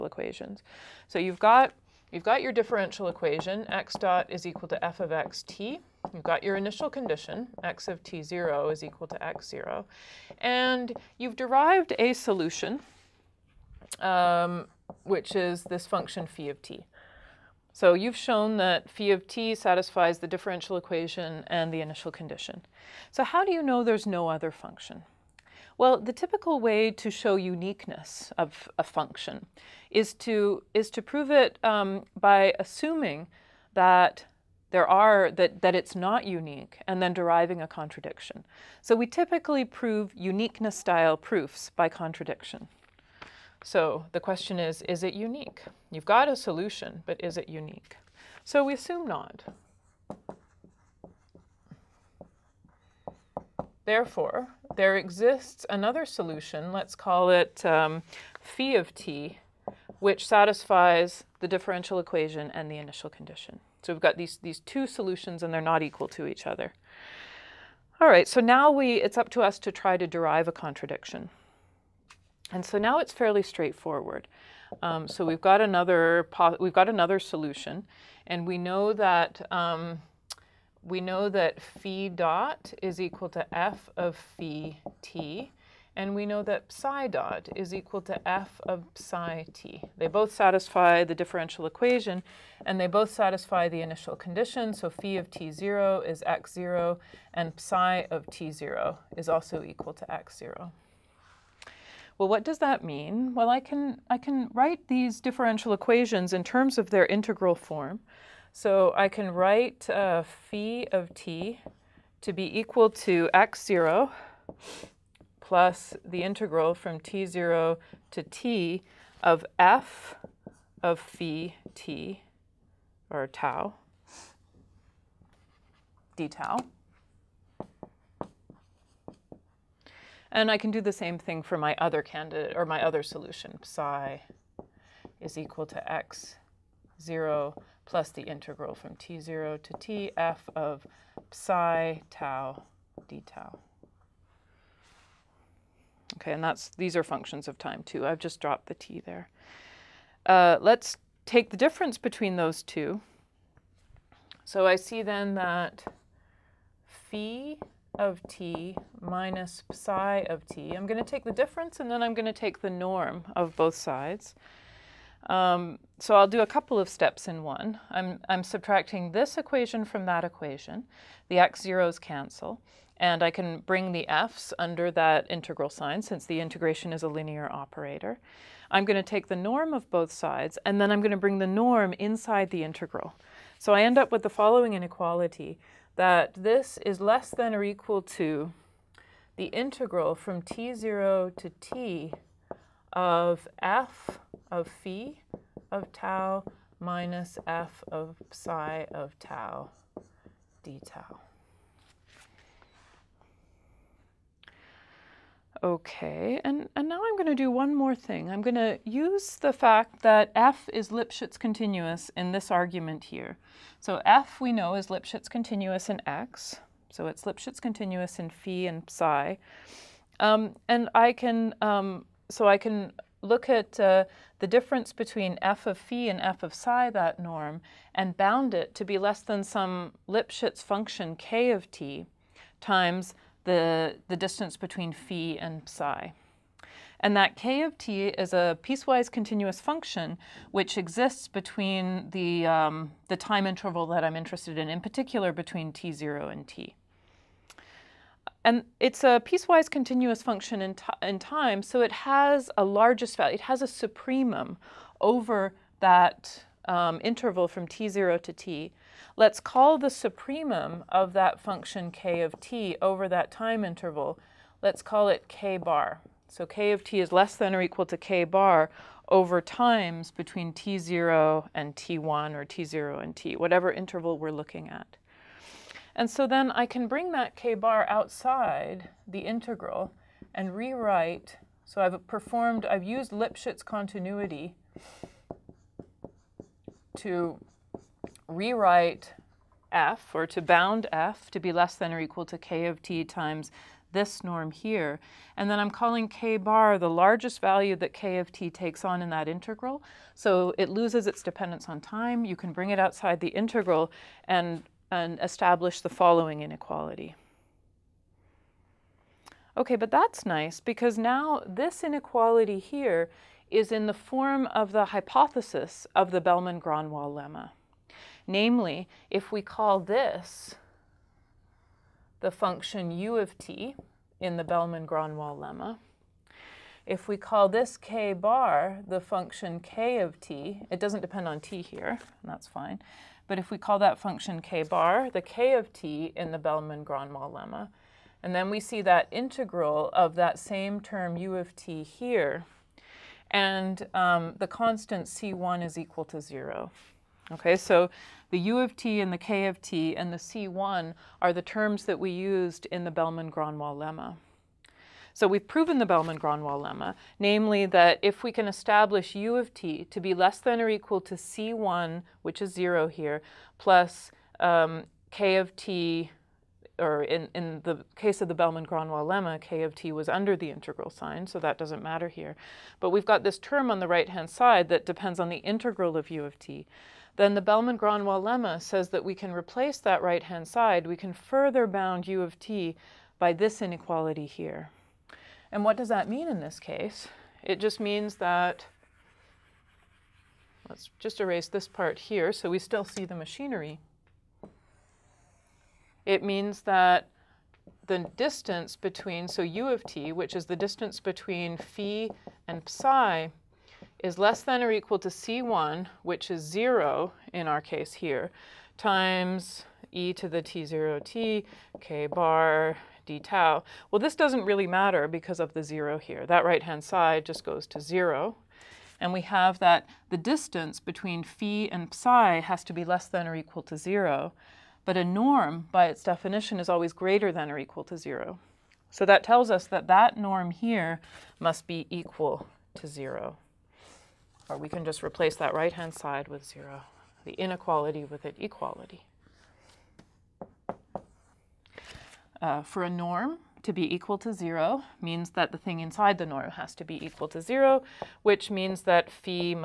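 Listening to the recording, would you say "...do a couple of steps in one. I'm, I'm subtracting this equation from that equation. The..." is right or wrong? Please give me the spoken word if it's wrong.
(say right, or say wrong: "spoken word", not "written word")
right.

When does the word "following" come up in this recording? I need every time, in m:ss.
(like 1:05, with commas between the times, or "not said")
3:04, 5:05.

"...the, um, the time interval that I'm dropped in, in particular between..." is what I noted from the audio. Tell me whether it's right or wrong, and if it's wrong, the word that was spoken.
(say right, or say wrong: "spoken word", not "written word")
wrong: "interested", not "dropped".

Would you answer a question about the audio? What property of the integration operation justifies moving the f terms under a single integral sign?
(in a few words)
Linear operator.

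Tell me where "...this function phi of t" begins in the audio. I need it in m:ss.
0:15.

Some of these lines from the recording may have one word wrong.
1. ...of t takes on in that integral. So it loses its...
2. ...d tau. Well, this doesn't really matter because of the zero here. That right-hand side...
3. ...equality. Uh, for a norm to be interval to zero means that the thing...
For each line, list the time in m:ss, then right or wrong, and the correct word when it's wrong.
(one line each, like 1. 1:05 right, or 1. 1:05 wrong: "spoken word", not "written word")
1. 4:58 right
2. 6:53 right
3. 7:18 wrong: "equal", not "interval".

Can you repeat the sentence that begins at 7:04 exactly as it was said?
But a norm, by its definition, is always greater than or equal to zero.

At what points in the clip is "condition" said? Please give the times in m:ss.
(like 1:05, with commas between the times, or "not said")
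0:06, 0:22, 1:03, 1:34.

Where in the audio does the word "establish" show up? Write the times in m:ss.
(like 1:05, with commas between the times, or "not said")
5:05, 5:58.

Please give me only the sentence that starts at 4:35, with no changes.
And so then I can bring that k-bar outside the integral and rewrite.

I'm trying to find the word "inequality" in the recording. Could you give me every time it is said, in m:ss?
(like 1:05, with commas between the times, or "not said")
3:04, 5:06, 5:11, 6:23, 7:17.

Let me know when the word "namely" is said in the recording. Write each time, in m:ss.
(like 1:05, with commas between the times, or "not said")
5:18, 5:57.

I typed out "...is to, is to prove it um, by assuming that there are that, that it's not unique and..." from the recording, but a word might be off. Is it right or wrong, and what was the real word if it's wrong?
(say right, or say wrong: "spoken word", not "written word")
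right.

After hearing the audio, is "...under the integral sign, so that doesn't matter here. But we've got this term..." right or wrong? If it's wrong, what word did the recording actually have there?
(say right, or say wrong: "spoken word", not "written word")
right.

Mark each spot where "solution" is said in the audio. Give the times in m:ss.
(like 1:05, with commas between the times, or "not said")
0:12, 0:46, 0:56, 1:04, 1:17, 2:13.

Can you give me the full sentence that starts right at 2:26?
Okay, and that's these are functions of time too.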